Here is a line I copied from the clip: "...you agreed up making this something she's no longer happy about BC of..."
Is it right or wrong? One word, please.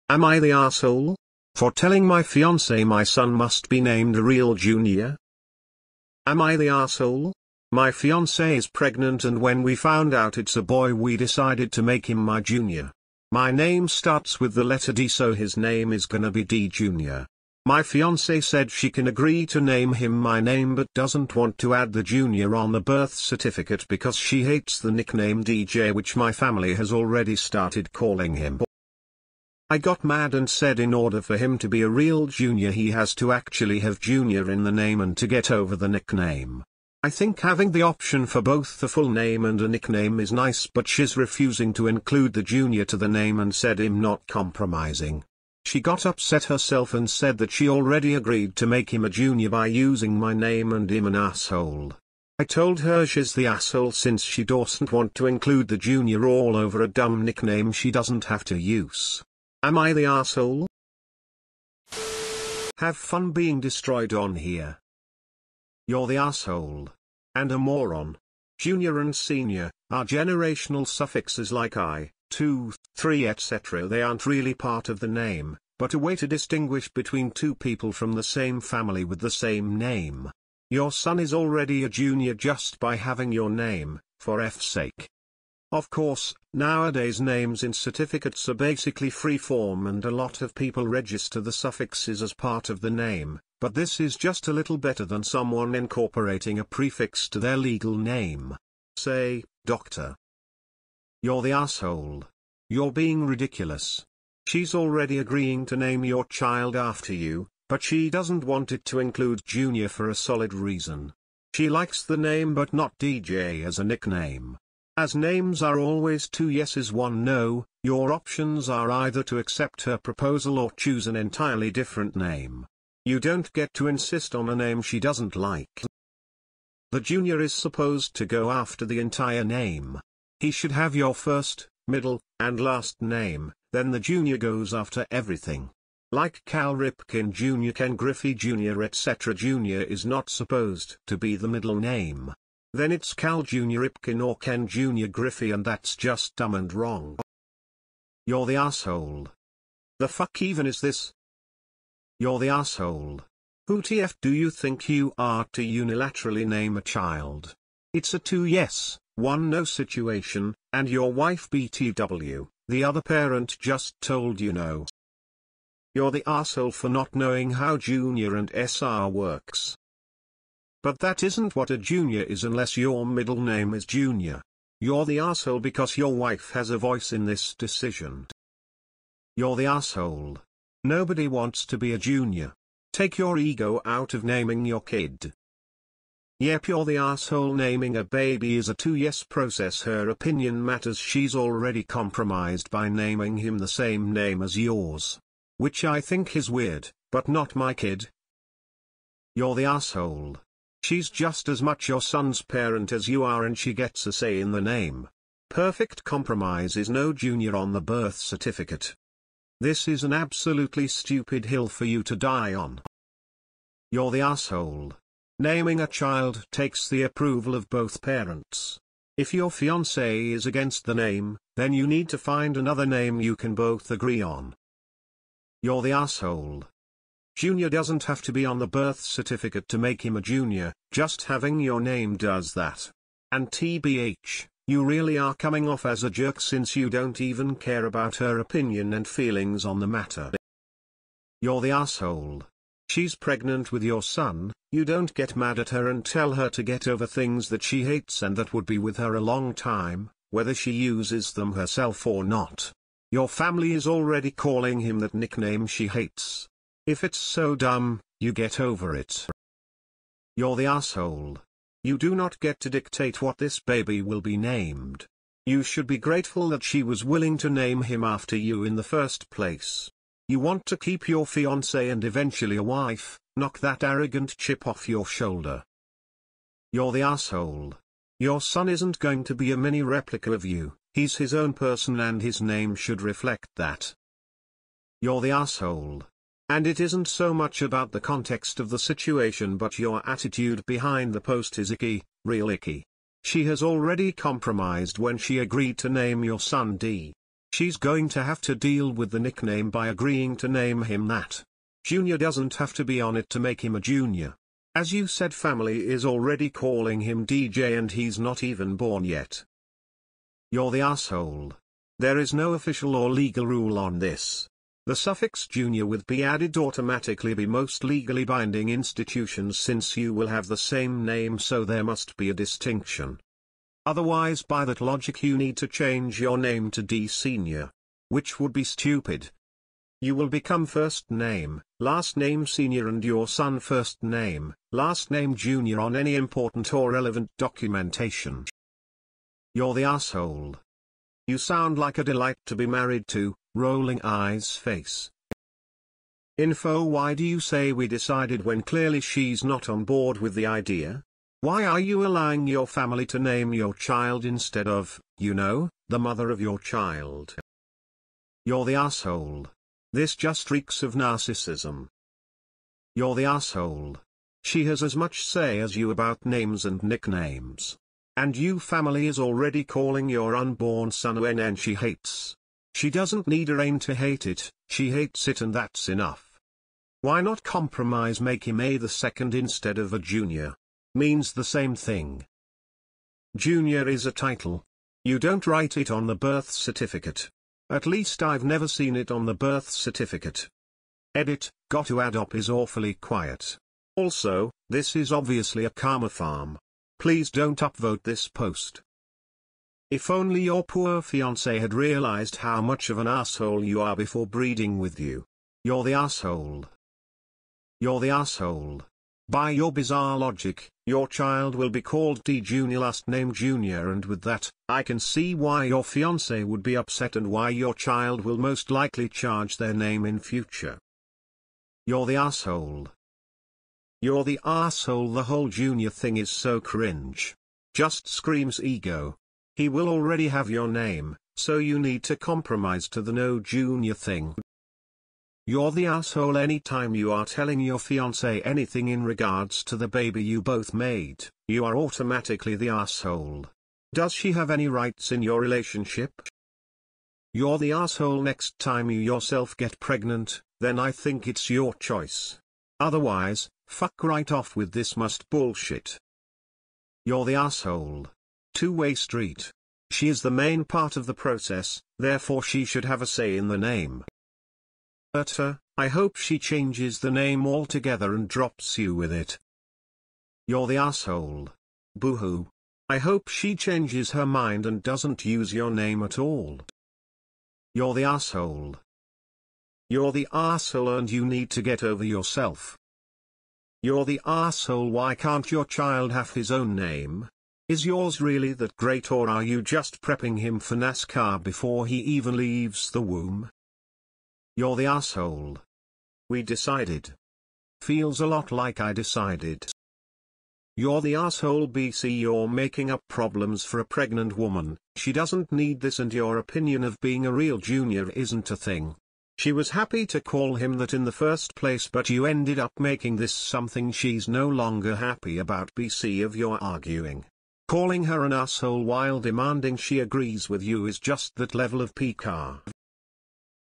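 wrong.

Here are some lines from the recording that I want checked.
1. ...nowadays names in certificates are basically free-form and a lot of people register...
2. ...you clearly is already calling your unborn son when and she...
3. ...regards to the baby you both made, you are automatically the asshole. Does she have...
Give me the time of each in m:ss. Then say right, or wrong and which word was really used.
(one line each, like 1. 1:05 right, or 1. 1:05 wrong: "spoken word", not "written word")
1. 1:26 right
2. 6:08 wrong: "family", not "clearly"
3. 7:19 right.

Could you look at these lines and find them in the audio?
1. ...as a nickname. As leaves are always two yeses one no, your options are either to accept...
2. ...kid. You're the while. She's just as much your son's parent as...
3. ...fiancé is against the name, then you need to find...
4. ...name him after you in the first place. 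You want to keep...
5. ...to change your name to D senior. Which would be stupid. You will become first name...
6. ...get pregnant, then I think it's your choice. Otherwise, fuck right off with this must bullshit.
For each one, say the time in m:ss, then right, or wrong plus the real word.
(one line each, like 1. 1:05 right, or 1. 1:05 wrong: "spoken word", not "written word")
1. 1:53 wrong: "names", not "leaves"
2. 3:17 wrong: "asshole", not "while"
3. 3:39 right
4. 4:27 right
5. 5:25 right
6. 7:29 right.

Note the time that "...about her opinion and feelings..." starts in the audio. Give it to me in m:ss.
3:57.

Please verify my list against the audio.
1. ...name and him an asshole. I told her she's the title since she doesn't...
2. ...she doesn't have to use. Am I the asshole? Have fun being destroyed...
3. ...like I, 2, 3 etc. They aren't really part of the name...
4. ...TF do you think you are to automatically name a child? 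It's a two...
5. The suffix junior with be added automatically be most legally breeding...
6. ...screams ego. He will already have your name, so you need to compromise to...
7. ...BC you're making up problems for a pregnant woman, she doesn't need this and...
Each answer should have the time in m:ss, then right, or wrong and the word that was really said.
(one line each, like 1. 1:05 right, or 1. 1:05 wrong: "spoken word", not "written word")
1. 0:50 wrong: "asshole", not "title"
2. 0:57 right
3. 1:11 right
4. 2:33 wrong: "unilaterally", not "automatically"
5. 5:14 wrong: "binding", not "breeding"
6. 7:08 right
7. 8:21 right.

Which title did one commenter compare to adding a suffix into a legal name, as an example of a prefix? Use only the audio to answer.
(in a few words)
Doctor.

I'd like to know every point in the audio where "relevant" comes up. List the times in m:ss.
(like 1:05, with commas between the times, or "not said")
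5:36.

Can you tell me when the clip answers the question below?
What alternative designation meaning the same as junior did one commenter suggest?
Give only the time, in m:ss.
6:18.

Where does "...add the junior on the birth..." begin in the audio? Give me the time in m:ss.
0:21.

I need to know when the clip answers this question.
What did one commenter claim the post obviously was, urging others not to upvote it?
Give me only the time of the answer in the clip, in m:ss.
6:35.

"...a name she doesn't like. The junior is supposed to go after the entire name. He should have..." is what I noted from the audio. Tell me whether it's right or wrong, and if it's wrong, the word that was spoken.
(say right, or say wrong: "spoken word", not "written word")
right.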